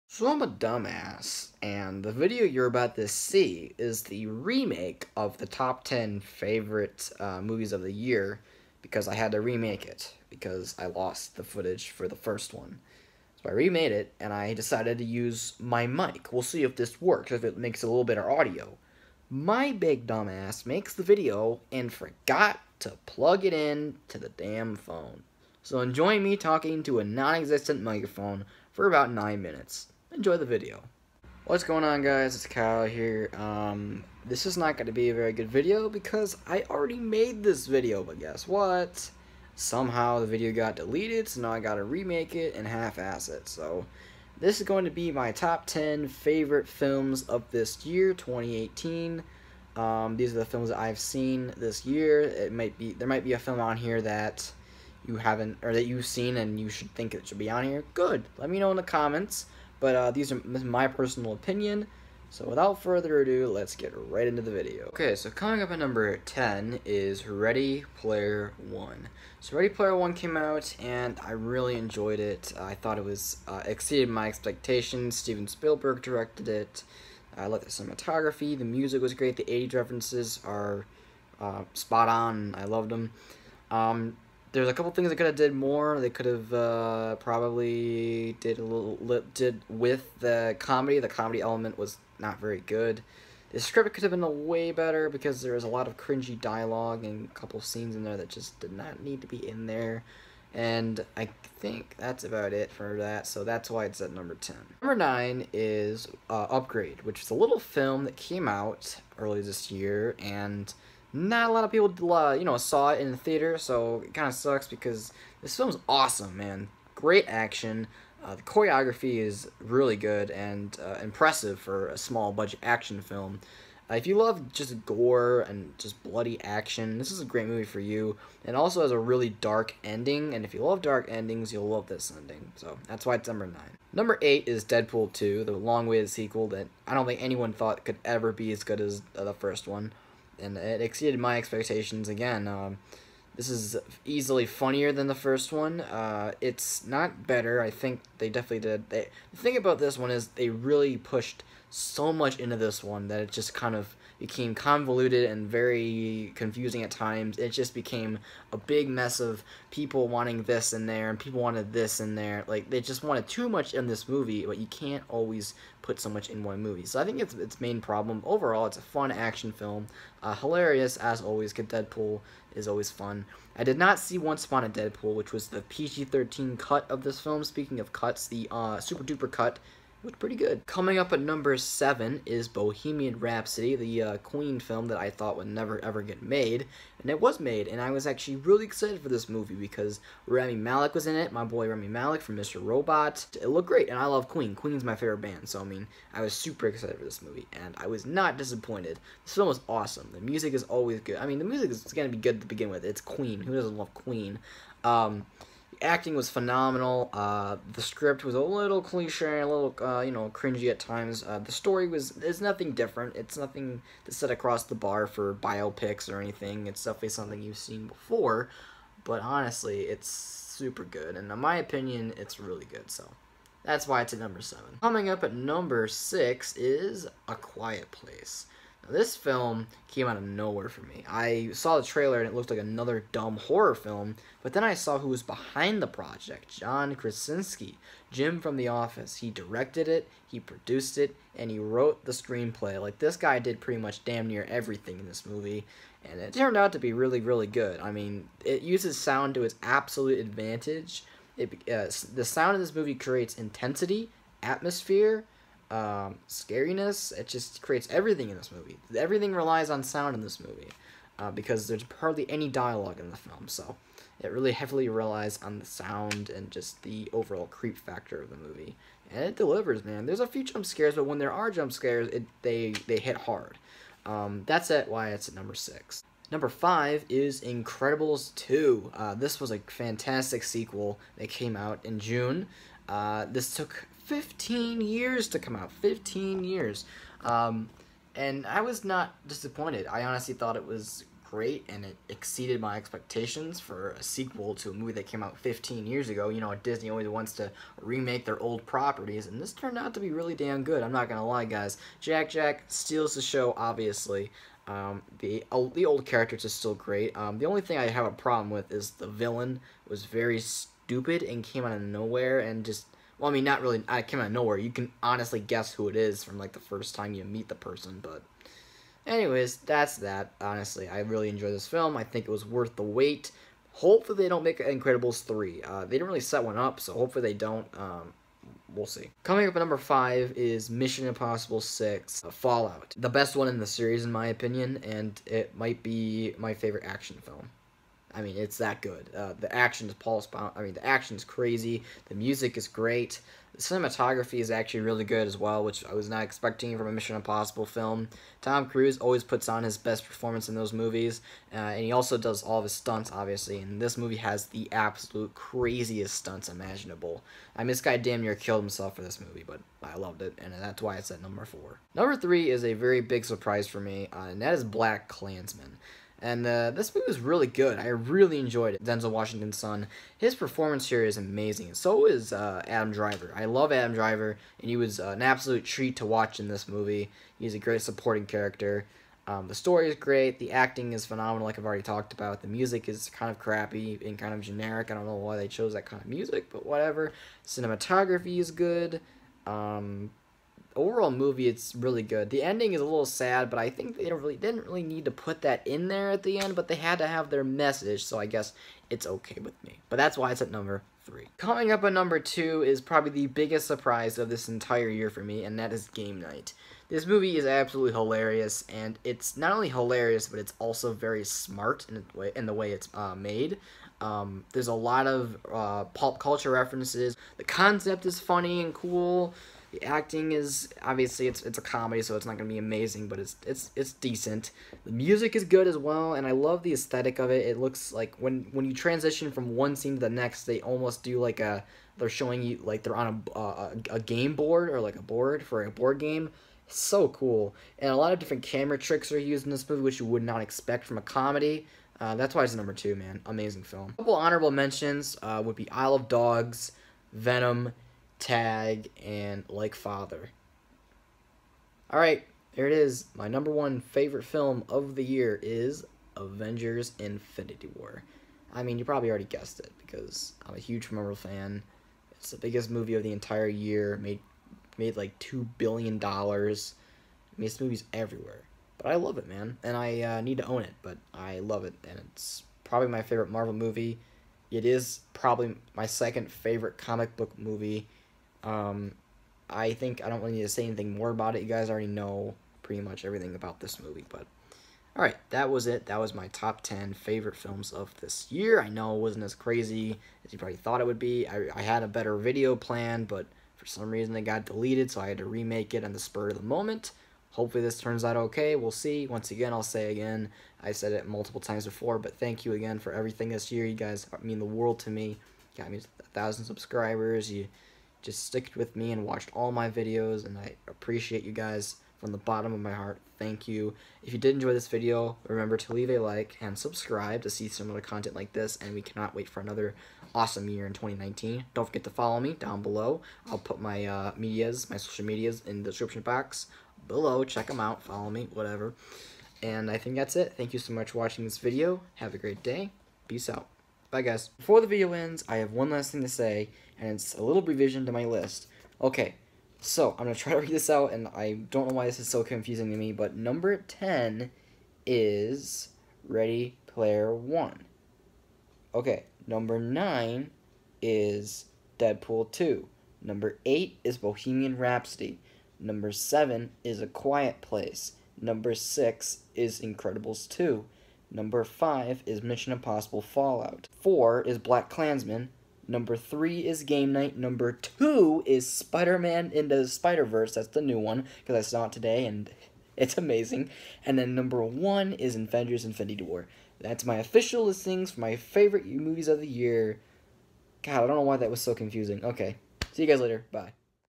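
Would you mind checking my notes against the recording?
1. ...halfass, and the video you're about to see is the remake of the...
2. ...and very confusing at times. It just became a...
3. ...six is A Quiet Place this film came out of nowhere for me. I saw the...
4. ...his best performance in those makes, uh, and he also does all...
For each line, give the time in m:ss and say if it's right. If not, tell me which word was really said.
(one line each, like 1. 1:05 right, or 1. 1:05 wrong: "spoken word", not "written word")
1. 0:00 wrong: "dumbass", not "halfass"
2. 2:35 right
3. 3:45 right
4. 5:49 wrong: "movies", not "makes".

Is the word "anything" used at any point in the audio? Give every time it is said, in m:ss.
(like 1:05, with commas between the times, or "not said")
3:36, 8:00.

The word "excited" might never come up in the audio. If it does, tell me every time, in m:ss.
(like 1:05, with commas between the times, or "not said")
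3:08, 3:16.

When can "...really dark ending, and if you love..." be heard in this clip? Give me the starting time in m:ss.
2:08.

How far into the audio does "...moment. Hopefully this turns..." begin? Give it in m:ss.
8:16.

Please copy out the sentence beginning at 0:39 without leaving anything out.
Somehow the video got deleted, so now I gotta remake it and half-ass it.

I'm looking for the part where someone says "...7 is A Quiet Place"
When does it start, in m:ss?
9:15.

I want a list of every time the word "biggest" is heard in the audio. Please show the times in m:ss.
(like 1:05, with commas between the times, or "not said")
6:43, 7:42.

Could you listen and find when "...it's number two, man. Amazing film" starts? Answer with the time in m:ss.
7:22.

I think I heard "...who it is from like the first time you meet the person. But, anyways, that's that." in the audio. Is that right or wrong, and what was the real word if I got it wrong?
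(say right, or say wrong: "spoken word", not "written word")
right.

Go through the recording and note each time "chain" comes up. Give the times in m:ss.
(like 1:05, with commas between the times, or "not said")
not said.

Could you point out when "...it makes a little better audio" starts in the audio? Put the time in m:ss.
0:17.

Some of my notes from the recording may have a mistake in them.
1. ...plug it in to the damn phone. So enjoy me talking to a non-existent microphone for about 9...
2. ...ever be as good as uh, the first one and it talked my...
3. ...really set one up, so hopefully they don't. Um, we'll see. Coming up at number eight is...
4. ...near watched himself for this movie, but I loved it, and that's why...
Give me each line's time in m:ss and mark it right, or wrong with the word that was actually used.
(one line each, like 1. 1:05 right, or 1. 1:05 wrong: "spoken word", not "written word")
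1. 0:23 right
2. 2:18 wrong: "exceeded", not "talked"
3. 5:26 wrong: "five", not "eight"
4. 5:58 wrong: "killed", not "watched".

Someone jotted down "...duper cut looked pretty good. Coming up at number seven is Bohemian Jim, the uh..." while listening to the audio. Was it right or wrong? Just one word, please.
wrong.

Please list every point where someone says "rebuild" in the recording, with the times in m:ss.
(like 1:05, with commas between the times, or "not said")
not said.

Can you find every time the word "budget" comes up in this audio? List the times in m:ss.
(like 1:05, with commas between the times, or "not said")
2:02.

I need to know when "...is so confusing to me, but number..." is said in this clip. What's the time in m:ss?
9:01.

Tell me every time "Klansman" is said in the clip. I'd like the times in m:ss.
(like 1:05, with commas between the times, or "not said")
6:05, 9:24.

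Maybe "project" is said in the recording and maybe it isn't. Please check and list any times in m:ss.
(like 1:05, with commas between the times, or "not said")
3:55.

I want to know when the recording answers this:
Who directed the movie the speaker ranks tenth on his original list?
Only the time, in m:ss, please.
1:15.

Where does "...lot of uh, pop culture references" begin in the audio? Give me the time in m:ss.
6:54.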